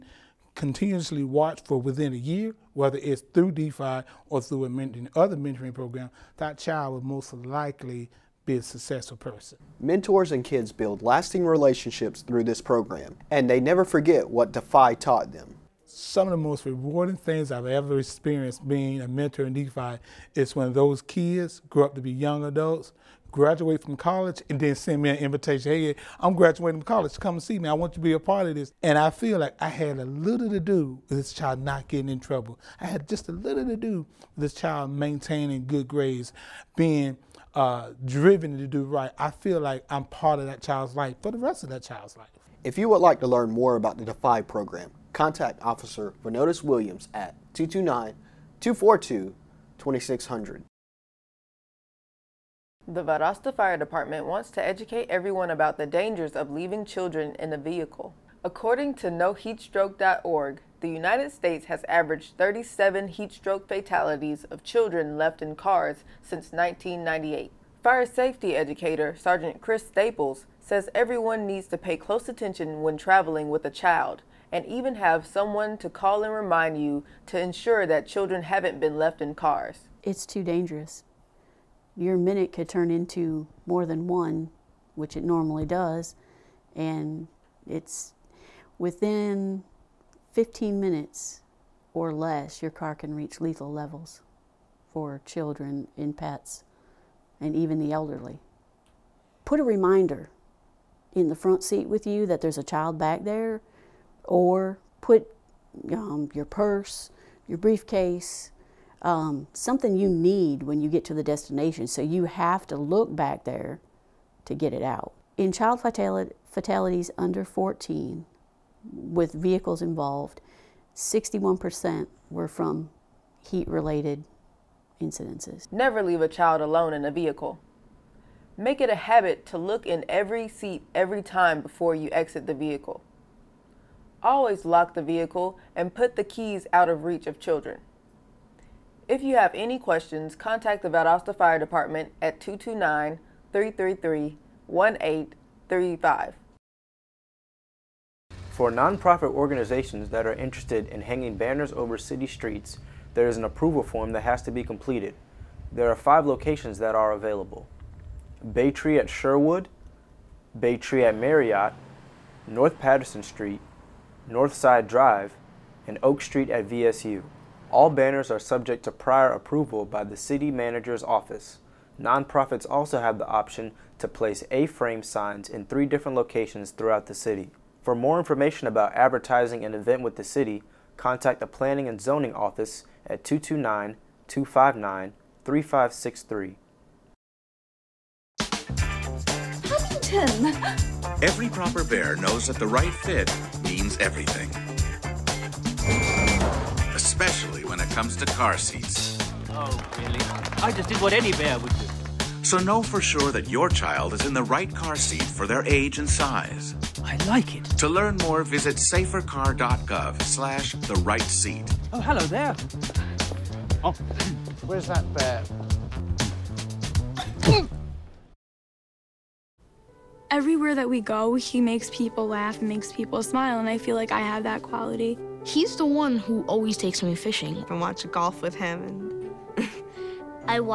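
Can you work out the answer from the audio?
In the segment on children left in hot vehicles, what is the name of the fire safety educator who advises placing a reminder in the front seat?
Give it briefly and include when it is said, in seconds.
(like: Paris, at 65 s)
Chris Staples, at 69 s.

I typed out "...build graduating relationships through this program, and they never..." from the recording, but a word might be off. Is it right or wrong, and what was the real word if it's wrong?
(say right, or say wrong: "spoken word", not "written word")
wrong: "lasting", not "graduating".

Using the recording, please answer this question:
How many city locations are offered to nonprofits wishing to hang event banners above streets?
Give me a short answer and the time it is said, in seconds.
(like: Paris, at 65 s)
5, at 155 s.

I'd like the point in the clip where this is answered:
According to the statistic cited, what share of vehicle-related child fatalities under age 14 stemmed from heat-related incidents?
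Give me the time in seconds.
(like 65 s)
120 s.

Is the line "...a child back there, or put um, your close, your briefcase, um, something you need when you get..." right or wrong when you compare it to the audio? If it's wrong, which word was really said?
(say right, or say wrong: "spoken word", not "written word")
wrong: "purse", not "close".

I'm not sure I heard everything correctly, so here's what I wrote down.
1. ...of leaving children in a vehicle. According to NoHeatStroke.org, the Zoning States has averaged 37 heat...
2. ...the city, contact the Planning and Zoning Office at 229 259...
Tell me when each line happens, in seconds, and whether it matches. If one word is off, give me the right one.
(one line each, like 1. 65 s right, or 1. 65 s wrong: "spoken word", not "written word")
1. 56 s wrong: "United", not "Zoning"
2. 180 s right.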